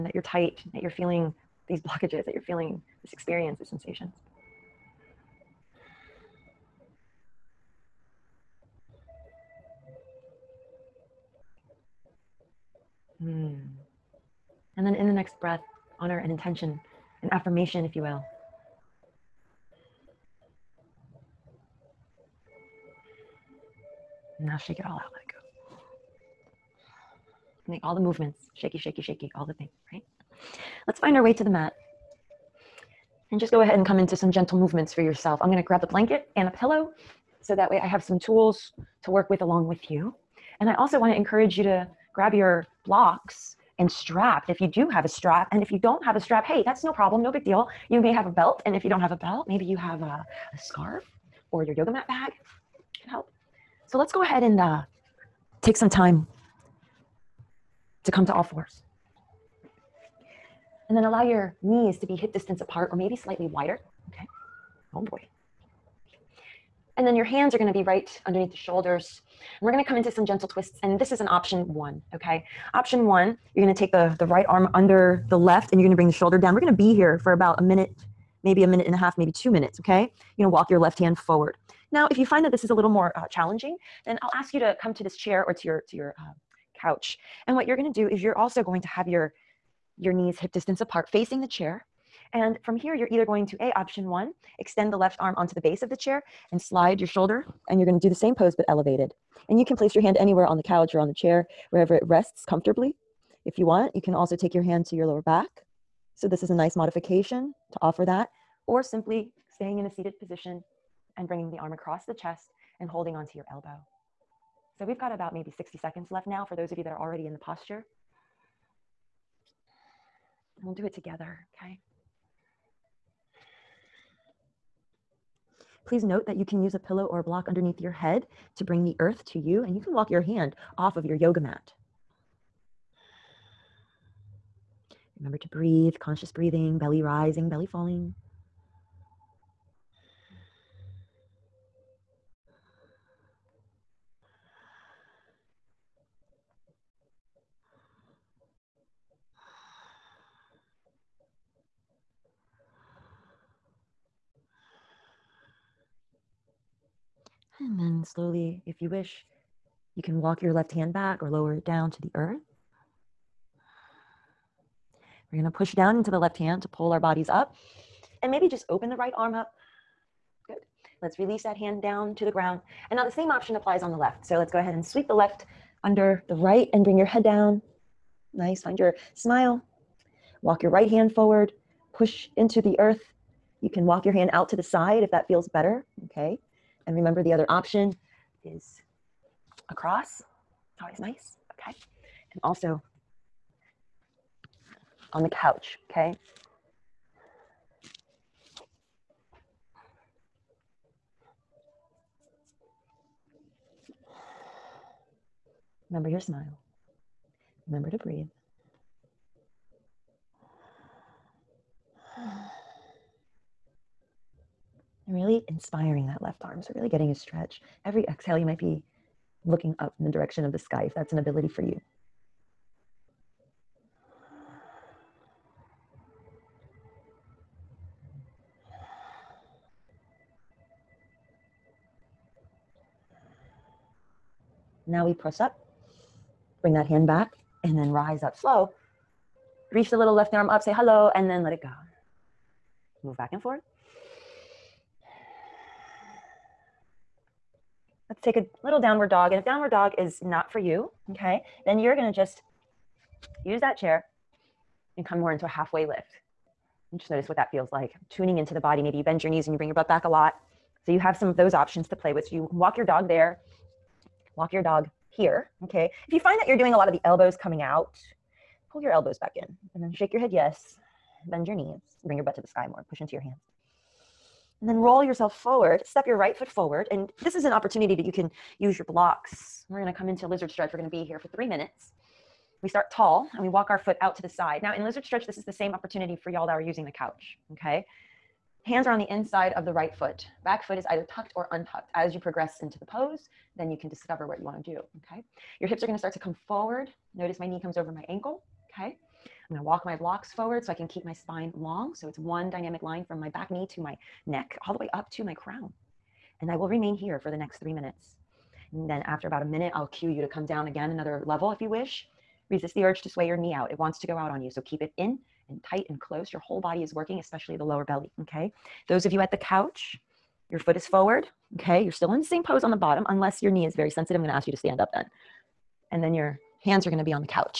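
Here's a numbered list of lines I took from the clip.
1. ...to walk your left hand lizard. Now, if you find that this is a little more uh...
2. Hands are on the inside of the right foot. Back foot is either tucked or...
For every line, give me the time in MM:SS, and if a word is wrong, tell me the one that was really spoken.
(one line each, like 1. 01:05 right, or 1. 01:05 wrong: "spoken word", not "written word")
1. 01:20 wrong: "forward", not "lizard"
2. 04:48 right.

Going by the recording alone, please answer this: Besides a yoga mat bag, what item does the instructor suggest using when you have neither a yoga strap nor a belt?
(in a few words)
A scarf.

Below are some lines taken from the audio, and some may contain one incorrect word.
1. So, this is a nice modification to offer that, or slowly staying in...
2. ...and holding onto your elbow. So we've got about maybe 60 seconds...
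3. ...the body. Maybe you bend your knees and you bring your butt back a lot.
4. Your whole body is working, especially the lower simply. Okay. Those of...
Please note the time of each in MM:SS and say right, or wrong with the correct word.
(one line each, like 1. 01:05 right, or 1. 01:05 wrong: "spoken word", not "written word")
1. 01:46 wrong: "simply", not "slowly"
2. 01:52 right
3. 04:18 right
4. 05:16 wrong: "belly", not "simply".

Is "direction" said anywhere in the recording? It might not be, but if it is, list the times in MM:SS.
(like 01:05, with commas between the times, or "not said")
03:40.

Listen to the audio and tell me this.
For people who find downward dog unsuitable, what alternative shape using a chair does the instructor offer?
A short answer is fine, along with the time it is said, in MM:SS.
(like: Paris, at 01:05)
Halfway lift, at 04:15.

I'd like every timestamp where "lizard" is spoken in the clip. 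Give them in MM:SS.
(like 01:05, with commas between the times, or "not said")
04:40, 04:44.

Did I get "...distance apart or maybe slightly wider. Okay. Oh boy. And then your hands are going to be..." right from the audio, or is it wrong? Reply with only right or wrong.
right.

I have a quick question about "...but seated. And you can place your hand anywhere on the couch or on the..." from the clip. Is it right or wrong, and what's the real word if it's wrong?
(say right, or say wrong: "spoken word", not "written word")
wrong: "elevated", not "seated".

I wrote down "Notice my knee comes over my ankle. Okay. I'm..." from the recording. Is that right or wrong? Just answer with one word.
right.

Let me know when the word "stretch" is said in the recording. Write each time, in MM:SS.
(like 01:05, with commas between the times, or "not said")
03:37, 04:40, 04:45.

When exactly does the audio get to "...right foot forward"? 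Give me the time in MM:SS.
04:36.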